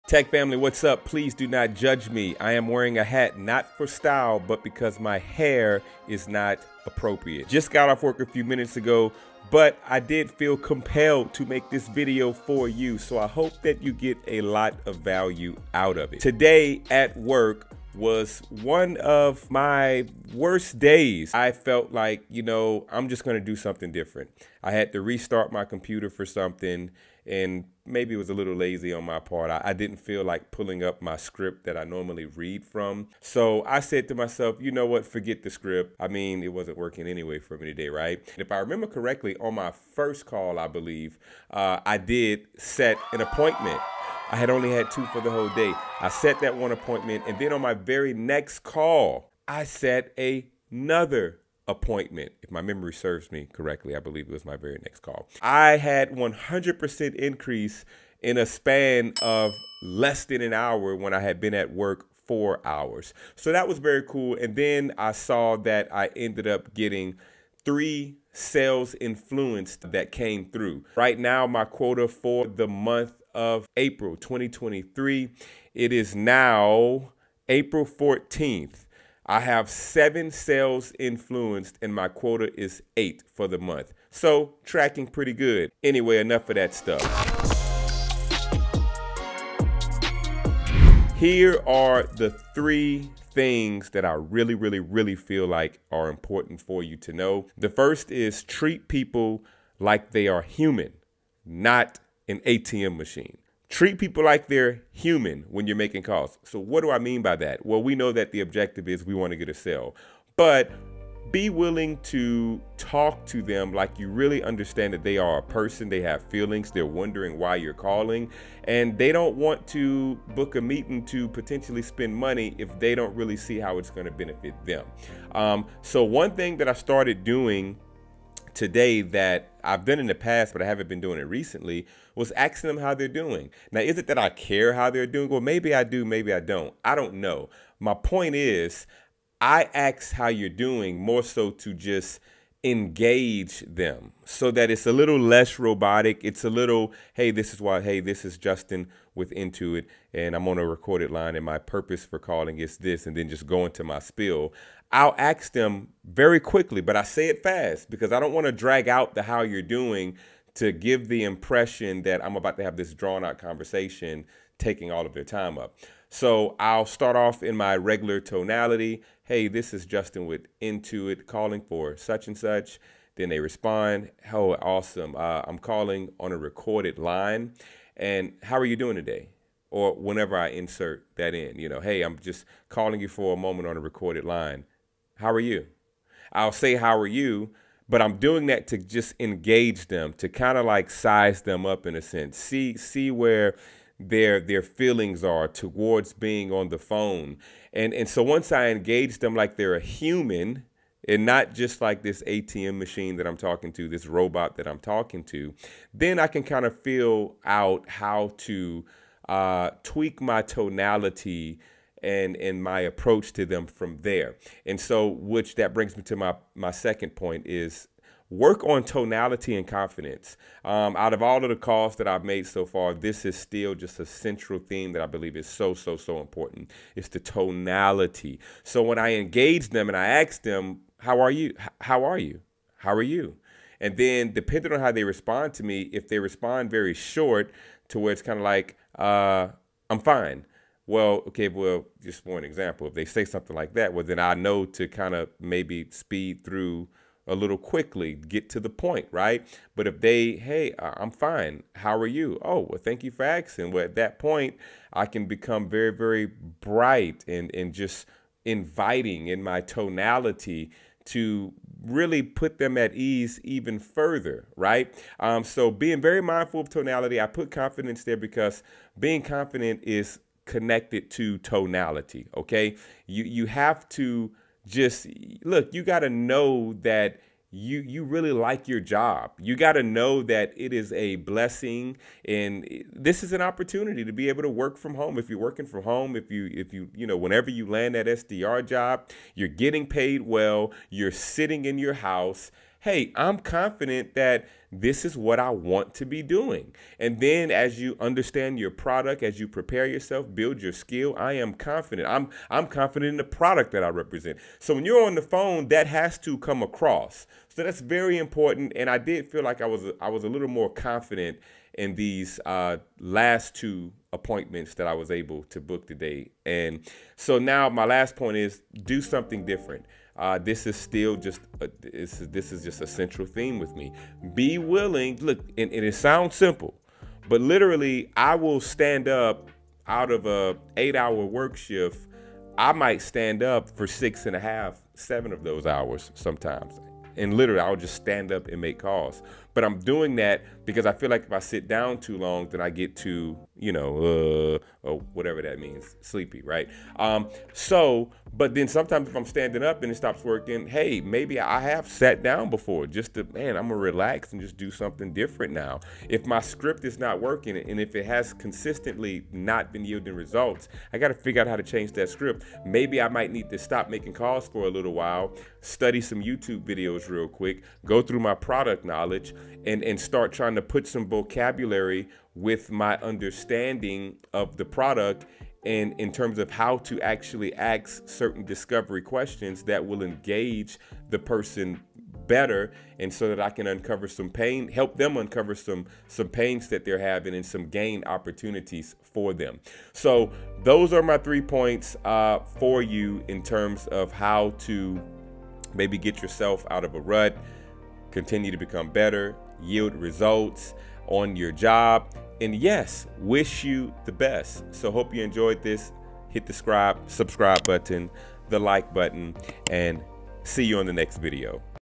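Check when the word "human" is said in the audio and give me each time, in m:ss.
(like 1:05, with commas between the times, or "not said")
1:40, 1:44, 3:19.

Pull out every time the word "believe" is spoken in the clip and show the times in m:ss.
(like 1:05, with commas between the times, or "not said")
0:40, 0:53, 3:45.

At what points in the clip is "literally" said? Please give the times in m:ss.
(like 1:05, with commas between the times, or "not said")
5:27, 5:37.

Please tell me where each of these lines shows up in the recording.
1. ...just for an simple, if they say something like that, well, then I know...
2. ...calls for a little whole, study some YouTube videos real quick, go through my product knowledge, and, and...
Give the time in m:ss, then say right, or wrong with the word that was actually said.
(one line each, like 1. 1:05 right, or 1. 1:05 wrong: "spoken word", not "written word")
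1. 4:02 wrong: "example", not "simple"
2. 6:04 wrong: "while", not "whole".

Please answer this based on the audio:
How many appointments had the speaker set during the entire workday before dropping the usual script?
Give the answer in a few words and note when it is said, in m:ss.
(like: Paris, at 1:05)
2, at 0:44.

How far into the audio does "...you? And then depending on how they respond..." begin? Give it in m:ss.
3:53.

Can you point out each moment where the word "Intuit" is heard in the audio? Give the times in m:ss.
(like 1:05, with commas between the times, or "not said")
2:29, 2:50.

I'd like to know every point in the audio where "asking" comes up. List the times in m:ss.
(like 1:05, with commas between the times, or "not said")
2:12, 4:13.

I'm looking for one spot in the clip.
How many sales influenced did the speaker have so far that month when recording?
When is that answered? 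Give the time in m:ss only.
1:19.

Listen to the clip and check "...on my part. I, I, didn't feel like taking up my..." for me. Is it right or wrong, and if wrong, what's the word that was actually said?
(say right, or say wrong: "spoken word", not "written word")
wrong: "pulling", not "taking".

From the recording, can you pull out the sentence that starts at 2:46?
So I'll start off in my regular tonality.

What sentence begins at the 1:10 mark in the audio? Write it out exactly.
Right now, my quota for the month of April 2023.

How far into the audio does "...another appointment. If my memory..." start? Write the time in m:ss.
0:50.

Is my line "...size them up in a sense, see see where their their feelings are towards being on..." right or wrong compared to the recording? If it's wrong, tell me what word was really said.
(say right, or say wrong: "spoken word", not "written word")
right.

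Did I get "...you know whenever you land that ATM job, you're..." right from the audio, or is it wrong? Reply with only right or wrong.
wrong.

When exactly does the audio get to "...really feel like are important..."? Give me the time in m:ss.
1:34.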